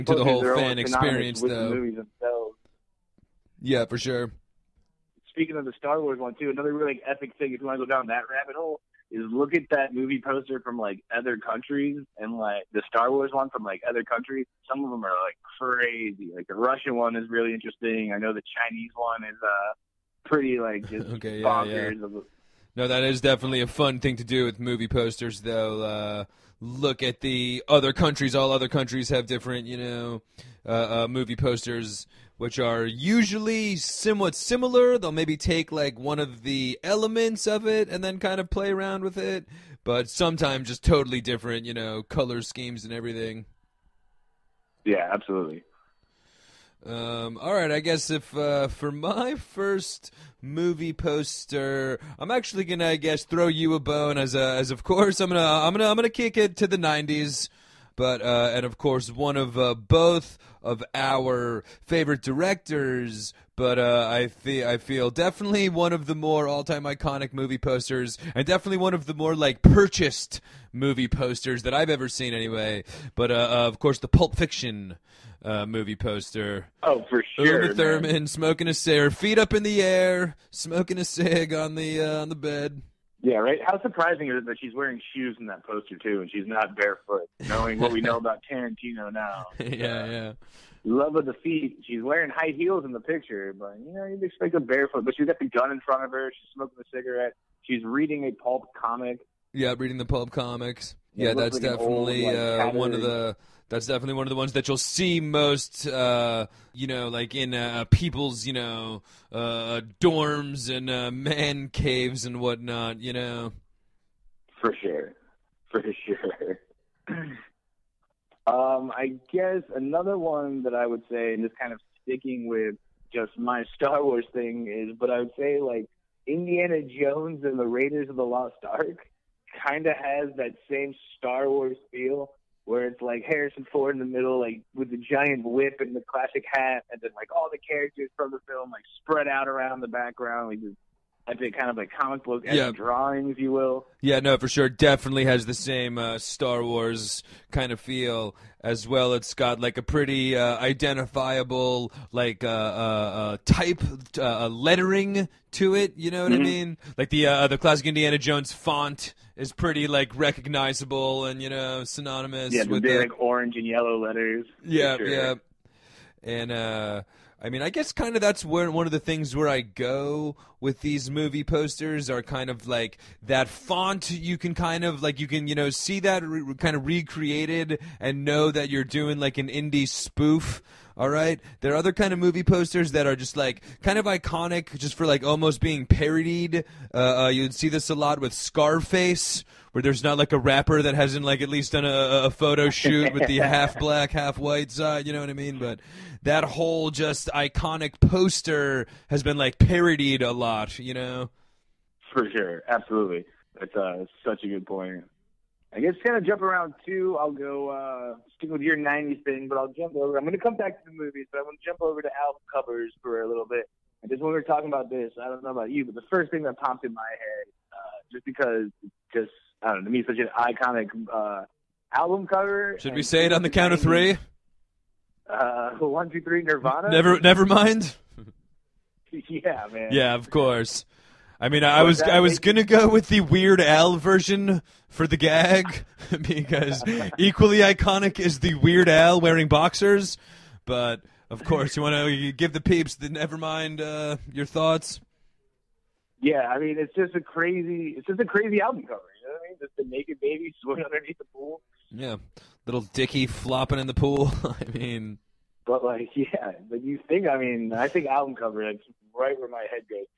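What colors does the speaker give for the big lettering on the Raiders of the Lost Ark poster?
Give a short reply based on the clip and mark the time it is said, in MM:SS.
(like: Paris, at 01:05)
Orange and yellow, at 02:43.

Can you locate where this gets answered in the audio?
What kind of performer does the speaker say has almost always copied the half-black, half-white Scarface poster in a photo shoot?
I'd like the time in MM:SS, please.
03:10.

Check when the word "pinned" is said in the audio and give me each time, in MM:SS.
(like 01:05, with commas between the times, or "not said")
not said.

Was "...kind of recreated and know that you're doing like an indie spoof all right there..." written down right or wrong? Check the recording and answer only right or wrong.
right.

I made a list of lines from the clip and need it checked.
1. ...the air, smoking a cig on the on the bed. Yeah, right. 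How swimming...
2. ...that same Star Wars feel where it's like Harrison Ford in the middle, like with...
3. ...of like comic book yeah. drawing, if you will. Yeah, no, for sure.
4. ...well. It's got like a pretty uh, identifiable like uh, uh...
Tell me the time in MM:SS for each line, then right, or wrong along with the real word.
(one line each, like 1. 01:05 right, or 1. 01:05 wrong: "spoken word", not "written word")
1. 01:19 wrong: "surprising", not "swimming"
2. 02:10 right
3. 02:21 right
4. 02:28 right.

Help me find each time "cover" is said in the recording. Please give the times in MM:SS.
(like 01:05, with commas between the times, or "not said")
03:32, 03:42, 04:08, 04:18.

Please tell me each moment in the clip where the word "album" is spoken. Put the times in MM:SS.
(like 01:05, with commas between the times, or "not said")
03:32, 03:41, 04:08, 04:18.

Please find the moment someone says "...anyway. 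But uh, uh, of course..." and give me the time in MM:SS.
01:12.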